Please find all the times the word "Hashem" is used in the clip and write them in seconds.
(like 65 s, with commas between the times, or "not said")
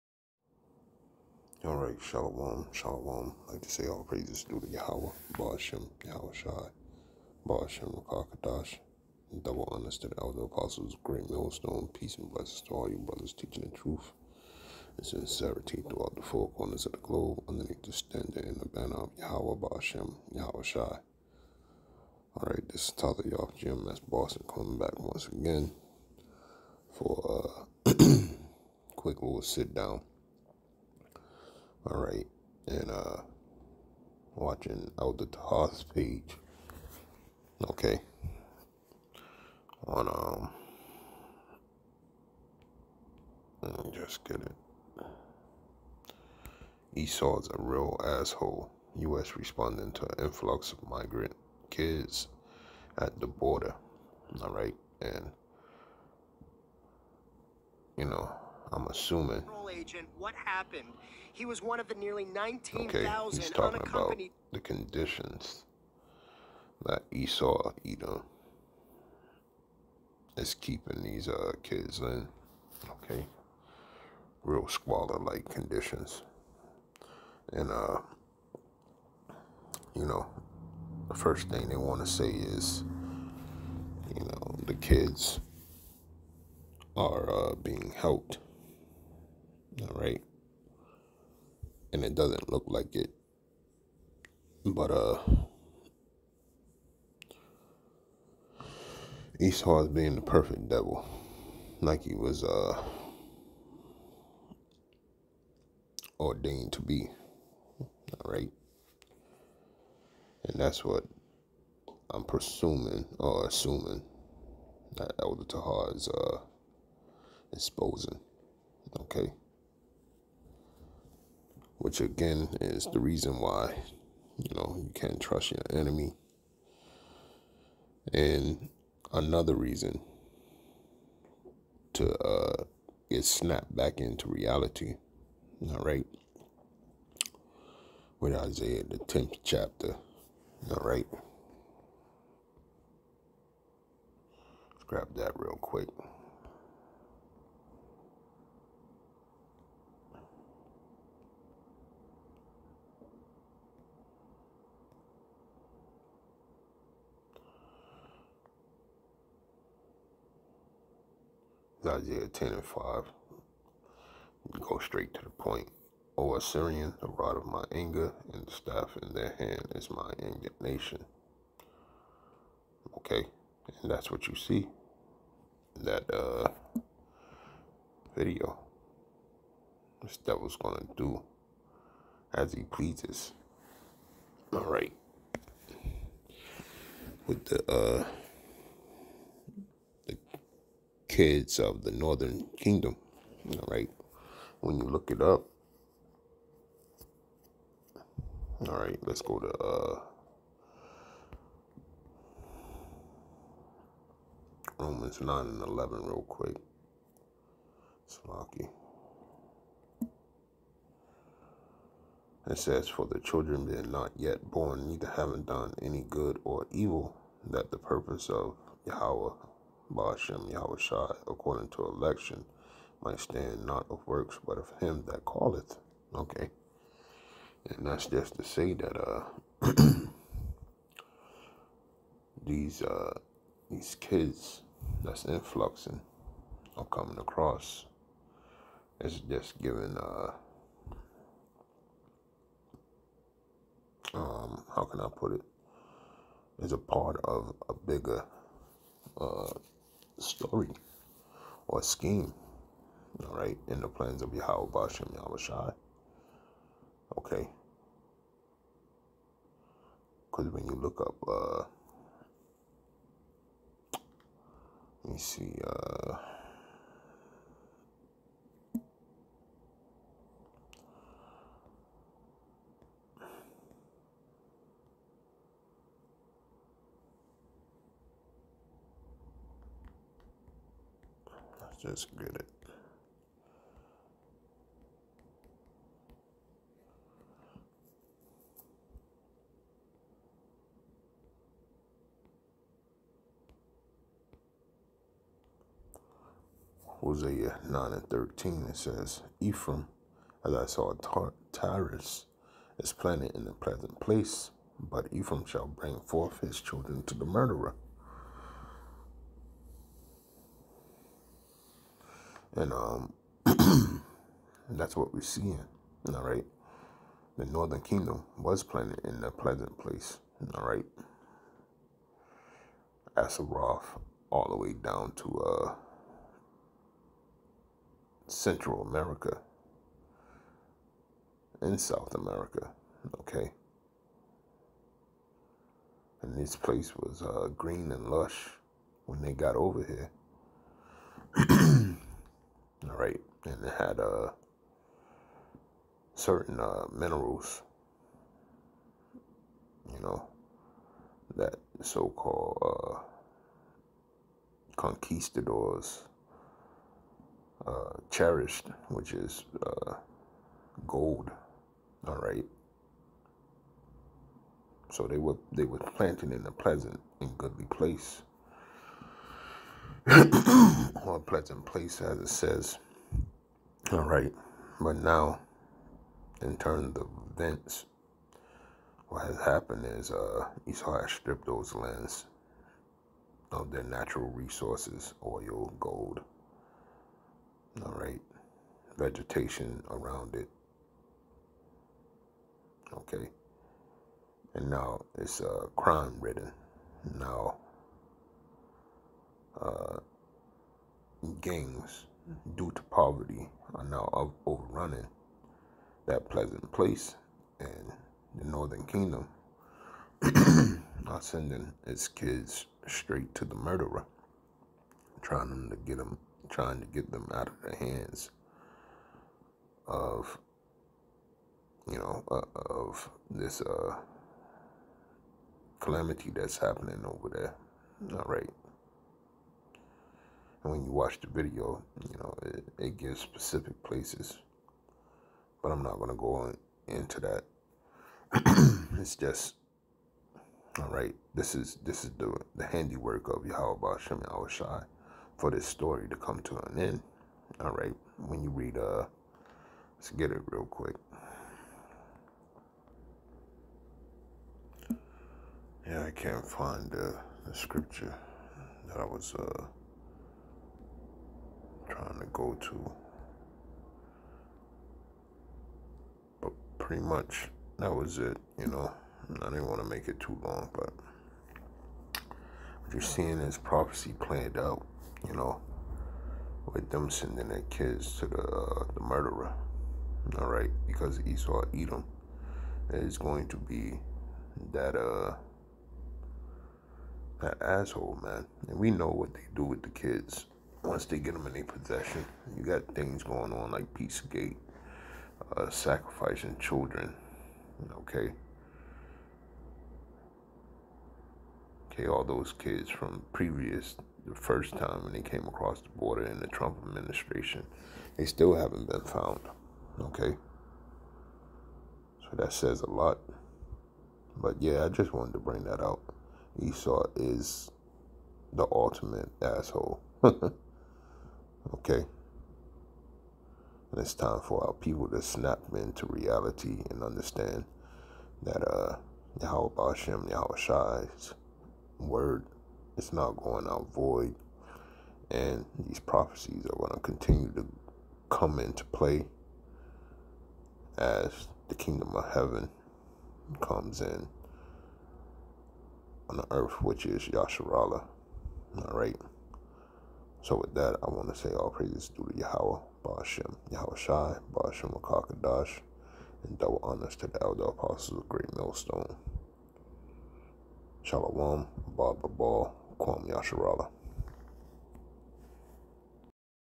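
220 s, 529 s.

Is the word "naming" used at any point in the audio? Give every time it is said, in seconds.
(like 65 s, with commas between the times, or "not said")
not said.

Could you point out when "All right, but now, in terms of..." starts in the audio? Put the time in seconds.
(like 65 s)
373 s.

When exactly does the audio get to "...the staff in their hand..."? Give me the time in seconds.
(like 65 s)
168 s.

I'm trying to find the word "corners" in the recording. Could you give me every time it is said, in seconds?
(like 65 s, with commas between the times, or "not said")
16 s.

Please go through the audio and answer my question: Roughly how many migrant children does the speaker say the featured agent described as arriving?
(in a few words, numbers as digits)
19,000.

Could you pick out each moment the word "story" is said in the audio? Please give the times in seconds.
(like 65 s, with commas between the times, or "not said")
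250 s, 445 s.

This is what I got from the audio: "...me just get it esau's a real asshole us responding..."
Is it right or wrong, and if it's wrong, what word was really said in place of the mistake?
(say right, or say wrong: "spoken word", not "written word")
right.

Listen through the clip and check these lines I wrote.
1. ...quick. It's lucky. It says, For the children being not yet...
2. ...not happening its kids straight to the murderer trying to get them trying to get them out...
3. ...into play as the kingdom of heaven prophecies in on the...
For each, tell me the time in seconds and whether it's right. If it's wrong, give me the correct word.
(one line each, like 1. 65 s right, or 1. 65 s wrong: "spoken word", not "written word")
1. 206 s right
2. 411 s wrong: "sending", not "happening"
3. 538 s wrong: "comes", not "prophecies".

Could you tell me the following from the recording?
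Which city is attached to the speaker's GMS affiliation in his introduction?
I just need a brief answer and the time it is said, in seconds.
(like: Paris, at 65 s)
Boston, at 24 s.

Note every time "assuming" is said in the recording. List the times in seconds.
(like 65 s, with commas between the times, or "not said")
58 s, 113 s.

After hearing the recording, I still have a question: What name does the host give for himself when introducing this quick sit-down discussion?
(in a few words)
Tyler York.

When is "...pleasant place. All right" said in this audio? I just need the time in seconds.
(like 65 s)
319 s.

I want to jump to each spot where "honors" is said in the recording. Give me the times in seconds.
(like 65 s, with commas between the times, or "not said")
9 s, 556 s.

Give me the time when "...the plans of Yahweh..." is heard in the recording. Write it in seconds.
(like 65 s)
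253 s.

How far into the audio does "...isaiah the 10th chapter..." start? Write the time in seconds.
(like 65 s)
138 s.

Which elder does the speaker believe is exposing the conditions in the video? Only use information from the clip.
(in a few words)
Elder Tahar.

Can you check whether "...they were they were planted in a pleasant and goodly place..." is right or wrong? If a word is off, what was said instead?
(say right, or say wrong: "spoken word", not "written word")
right.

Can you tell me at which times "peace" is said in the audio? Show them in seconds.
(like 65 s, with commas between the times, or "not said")
11 s, 493 s.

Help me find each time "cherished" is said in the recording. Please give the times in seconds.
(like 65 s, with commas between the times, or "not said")
358 s.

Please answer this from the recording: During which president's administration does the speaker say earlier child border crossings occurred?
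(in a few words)
Trump.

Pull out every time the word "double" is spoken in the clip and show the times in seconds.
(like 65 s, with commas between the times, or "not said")
9 s, 556 s.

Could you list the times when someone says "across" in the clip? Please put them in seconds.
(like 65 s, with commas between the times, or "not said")
237 s, 505 s.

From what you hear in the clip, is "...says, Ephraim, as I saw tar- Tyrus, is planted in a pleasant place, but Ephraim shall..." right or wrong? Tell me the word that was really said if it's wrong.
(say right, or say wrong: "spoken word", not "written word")
right.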